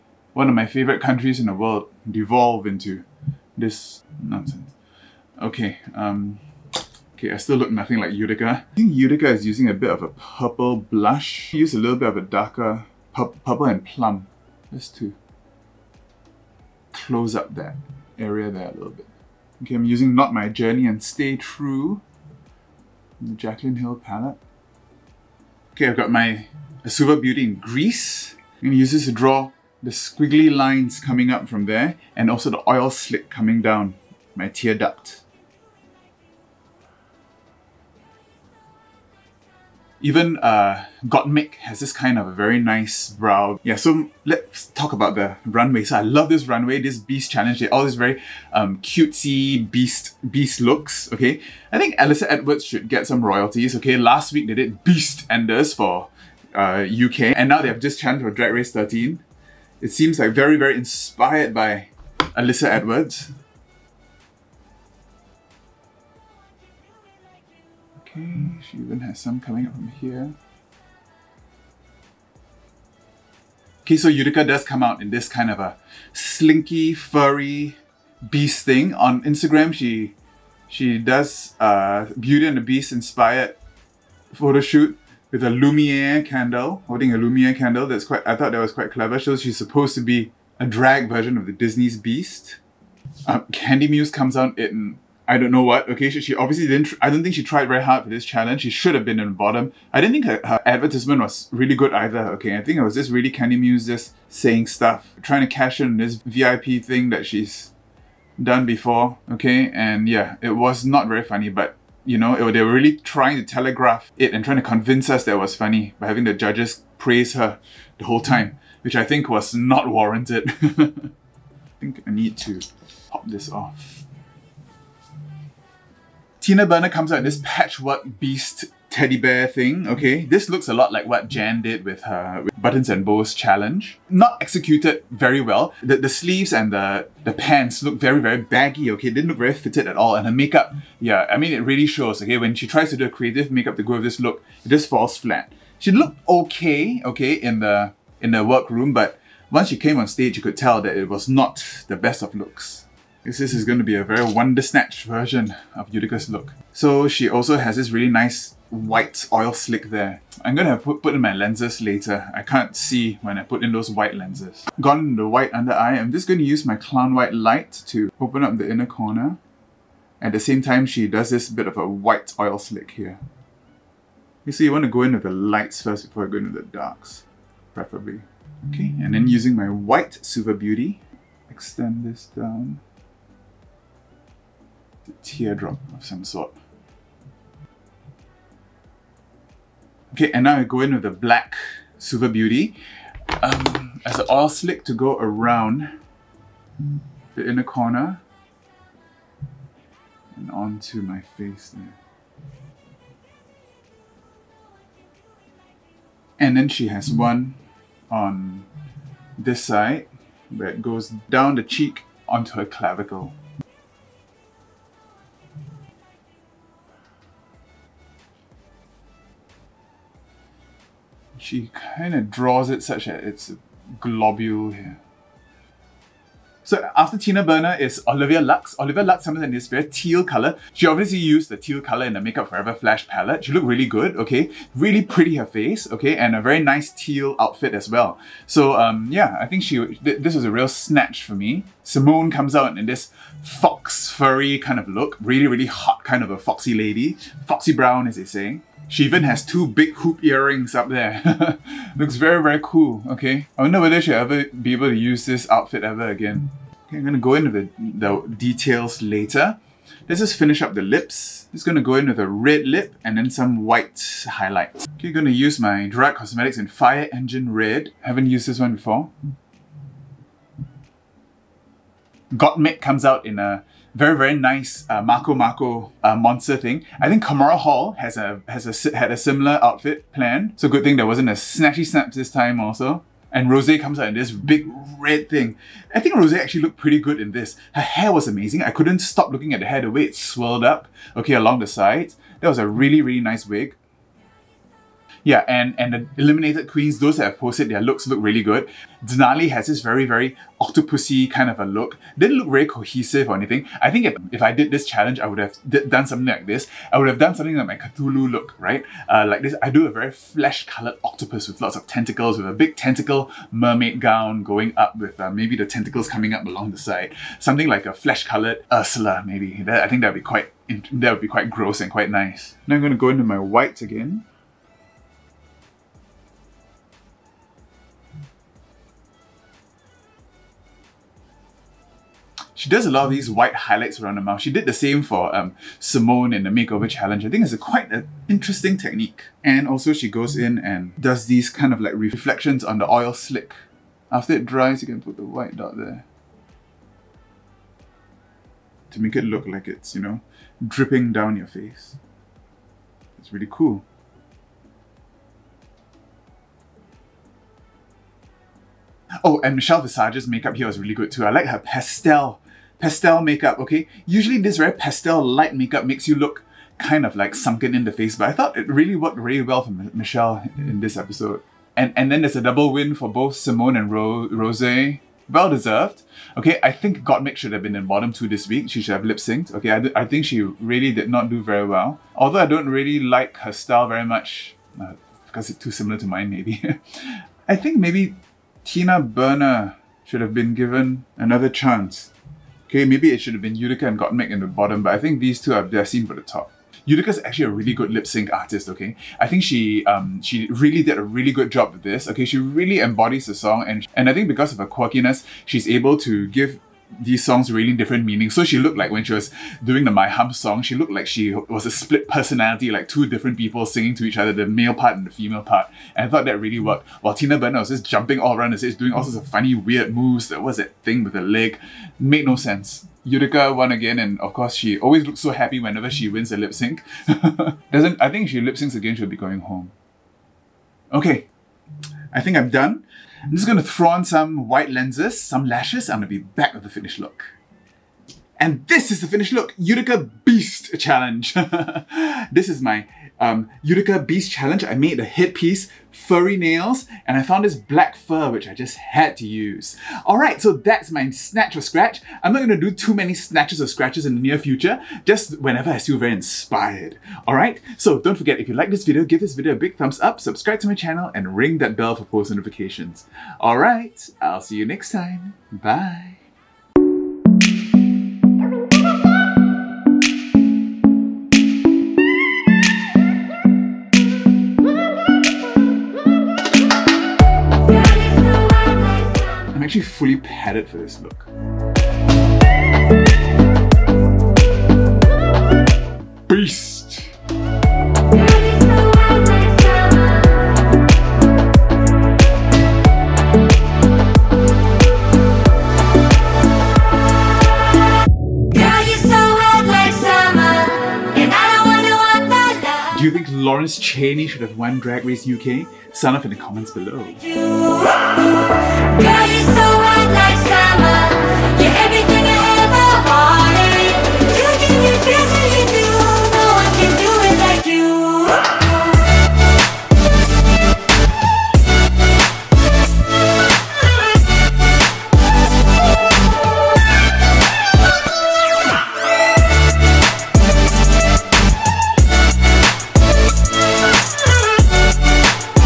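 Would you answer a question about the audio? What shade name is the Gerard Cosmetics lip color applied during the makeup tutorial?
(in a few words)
Fire Engine Red.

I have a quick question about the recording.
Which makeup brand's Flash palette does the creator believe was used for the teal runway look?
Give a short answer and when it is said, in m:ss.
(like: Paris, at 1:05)
Makeup Forever, at 3:52.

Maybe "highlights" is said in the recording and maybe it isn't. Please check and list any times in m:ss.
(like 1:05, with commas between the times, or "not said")
4:24, 5:33.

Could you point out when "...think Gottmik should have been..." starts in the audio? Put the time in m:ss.
6:16.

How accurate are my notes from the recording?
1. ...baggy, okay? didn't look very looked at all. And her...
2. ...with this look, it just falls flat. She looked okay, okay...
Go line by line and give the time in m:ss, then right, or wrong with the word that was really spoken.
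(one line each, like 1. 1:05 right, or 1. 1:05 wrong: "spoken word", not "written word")
1. 2:18 wrong: "fitted", not "looked"
2. 2:23 right.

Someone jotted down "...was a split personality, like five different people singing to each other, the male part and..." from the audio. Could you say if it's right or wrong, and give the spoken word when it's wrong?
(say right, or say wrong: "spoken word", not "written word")
wrong: "two", not "five".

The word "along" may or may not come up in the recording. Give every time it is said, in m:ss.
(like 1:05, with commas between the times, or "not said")
4:51, 5:16.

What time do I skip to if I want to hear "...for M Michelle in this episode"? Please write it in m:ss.
6:09.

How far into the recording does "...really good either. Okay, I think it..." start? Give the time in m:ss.
1:41.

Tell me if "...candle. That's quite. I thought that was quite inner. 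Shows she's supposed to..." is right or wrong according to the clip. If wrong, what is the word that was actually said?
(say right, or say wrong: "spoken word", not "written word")
wrong: "clever", not "inner".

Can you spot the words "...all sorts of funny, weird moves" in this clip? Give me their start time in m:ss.
6:58.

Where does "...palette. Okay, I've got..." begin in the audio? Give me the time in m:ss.
0:23.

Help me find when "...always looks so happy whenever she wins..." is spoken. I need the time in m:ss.
7:04.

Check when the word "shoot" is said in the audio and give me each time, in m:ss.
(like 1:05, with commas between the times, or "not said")
1:24.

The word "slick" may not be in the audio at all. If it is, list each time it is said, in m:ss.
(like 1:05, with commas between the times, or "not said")
0:32, 2:39, 2:52, 3:14, 5:43.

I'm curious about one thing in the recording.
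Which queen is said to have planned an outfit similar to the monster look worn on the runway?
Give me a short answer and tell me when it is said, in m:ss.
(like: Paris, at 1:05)
Kahmora Hall, at 4:37.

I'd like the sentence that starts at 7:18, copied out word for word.
And this is the finished look, Utica Beast Challenge.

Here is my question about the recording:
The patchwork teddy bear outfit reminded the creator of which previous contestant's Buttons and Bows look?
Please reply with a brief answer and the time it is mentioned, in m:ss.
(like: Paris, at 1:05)
Jan, at 2:11.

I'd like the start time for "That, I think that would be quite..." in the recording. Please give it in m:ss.
5:19.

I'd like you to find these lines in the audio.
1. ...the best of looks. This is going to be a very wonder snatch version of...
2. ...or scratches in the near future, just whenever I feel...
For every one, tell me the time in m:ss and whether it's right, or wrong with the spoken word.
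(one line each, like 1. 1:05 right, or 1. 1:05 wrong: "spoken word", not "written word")
1. 2:31 right
2. 7:33 right.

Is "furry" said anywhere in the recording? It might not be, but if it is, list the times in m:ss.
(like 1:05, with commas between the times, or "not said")
1:16, 4:04, 7:25.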